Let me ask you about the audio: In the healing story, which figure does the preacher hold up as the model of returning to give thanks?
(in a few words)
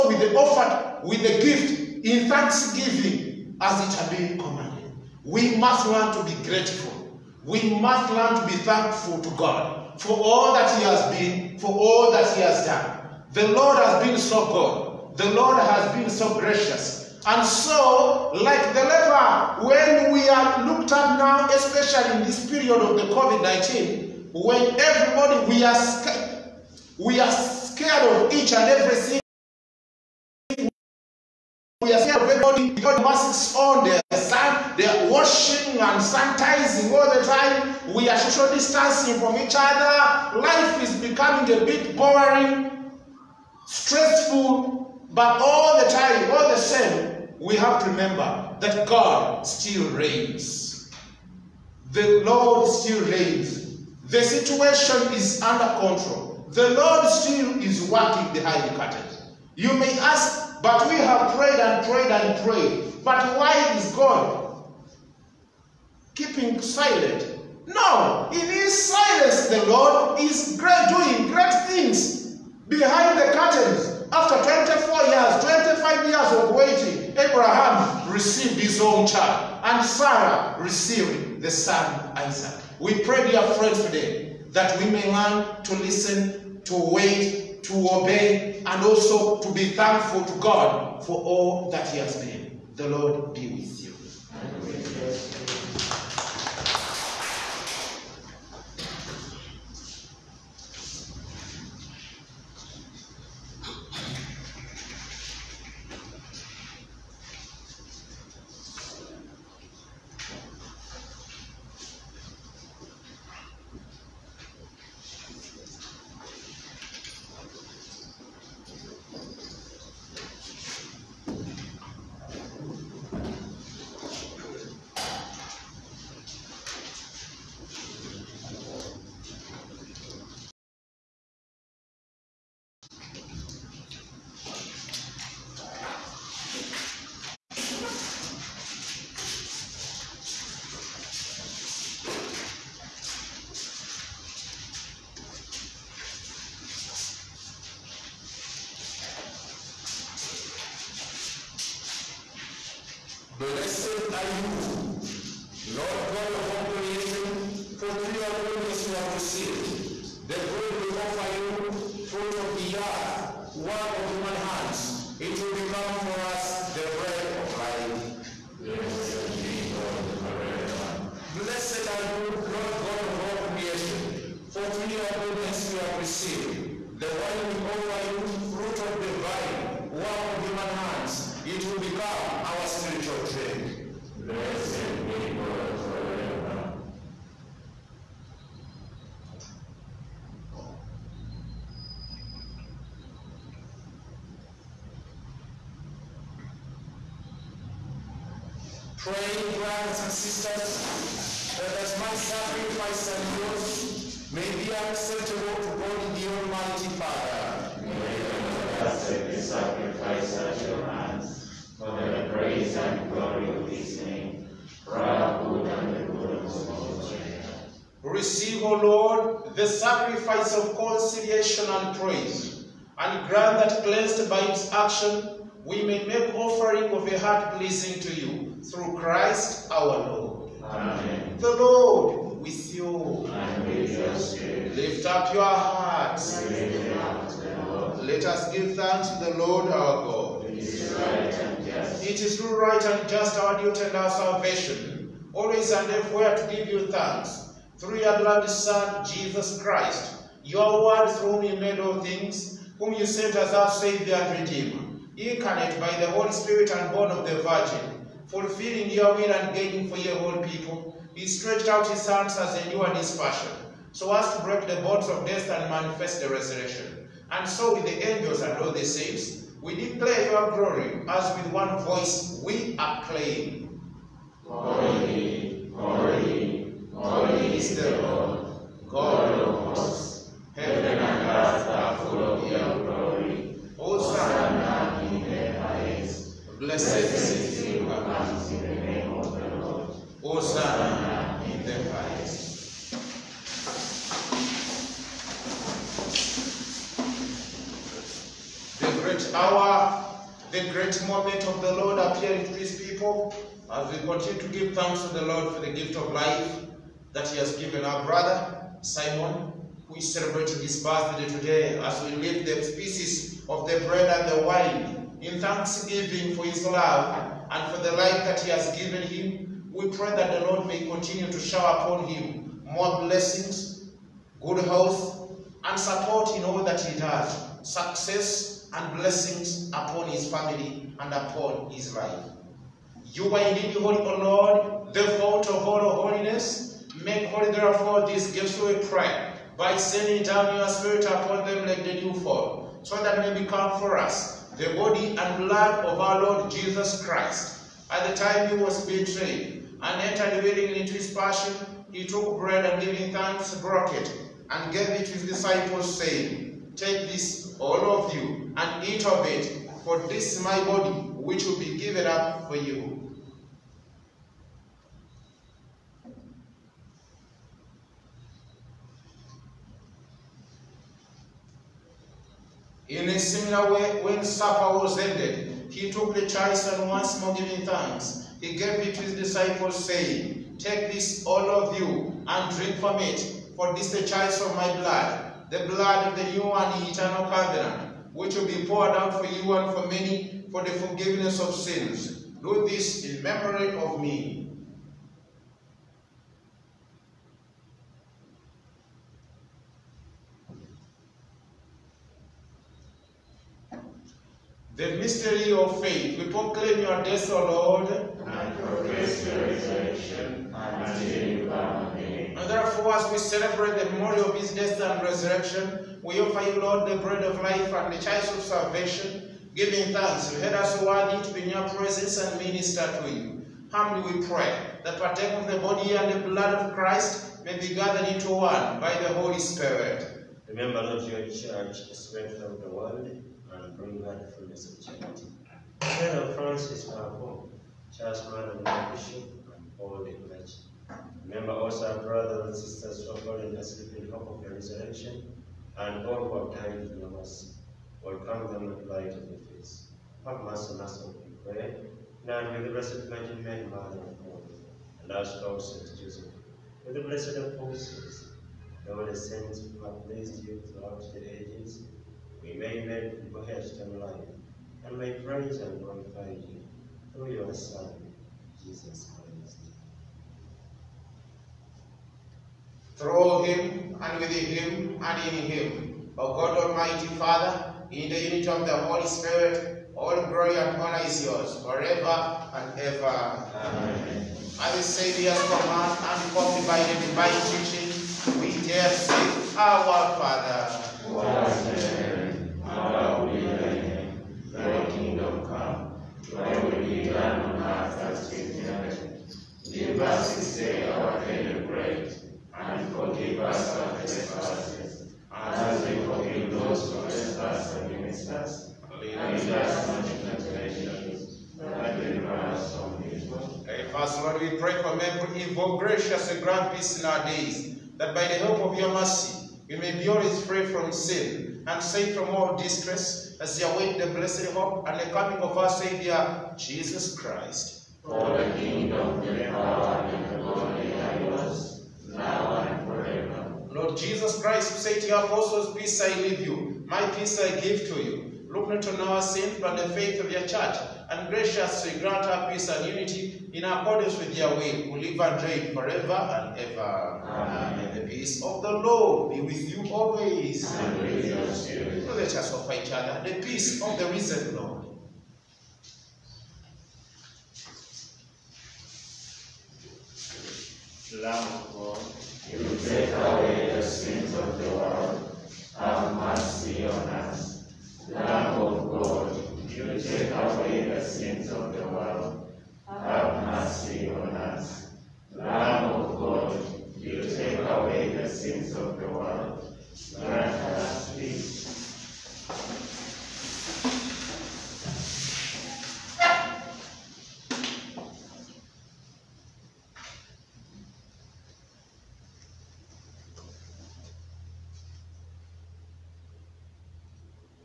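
the leper.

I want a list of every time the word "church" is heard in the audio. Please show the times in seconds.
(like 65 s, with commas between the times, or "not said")
431 s, 540 s.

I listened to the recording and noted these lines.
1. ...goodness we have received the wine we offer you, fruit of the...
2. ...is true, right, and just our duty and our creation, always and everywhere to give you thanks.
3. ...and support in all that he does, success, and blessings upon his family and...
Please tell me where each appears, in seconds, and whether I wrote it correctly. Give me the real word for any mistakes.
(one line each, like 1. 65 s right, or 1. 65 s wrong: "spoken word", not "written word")
1. 175 s right
2. 240 s wrong: "salvation", not "creation"
3. 325 s right.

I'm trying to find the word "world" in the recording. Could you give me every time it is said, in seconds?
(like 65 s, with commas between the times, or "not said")
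432 s, 564 s.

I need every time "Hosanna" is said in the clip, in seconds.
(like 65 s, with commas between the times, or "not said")
283 s, 290 s.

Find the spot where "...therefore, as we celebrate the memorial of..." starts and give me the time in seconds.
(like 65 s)
412 s.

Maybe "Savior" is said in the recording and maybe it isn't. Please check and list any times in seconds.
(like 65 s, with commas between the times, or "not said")
253 s, 484 s, 525 s.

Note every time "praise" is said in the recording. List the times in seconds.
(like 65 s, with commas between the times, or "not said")
221 s, 465 s.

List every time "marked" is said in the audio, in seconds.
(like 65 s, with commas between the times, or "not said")
not said.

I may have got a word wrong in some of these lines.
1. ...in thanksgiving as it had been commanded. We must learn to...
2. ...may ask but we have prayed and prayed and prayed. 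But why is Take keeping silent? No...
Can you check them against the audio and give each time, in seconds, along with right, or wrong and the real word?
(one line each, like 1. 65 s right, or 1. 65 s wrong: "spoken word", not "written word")
1. 2 s right
2. 59 s wrong: "God", not "Take".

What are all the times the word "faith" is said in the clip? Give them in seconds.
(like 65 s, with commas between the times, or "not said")
405 s, 539 s.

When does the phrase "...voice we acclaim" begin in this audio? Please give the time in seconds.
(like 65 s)
271 s.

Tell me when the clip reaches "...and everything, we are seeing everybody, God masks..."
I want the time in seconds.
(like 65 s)
28 s.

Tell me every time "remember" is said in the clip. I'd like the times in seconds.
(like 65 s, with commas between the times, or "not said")
47 s, 430 s, 441 s.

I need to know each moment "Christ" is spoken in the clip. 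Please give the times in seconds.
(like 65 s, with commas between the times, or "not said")
228 s, 249 s, 347 s, 426 s, 469 s, 527 s, 534 s.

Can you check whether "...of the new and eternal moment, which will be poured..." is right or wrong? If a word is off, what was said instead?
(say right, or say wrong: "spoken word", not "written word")
wrong: "covenant", not "moment".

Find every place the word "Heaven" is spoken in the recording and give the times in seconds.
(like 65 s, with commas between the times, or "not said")
280 s.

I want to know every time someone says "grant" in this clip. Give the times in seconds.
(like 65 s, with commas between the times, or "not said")
223 s, 516 s, 541 s.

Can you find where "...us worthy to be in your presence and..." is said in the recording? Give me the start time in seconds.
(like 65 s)
420 s.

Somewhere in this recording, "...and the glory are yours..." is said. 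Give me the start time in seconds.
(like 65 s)
530 s.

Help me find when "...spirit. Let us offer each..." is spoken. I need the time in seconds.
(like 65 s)
551 s.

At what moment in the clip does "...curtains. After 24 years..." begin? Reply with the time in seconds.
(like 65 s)
73 s.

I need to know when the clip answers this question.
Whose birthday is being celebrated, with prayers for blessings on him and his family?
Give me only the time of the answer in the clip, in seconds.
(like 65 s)
308 s.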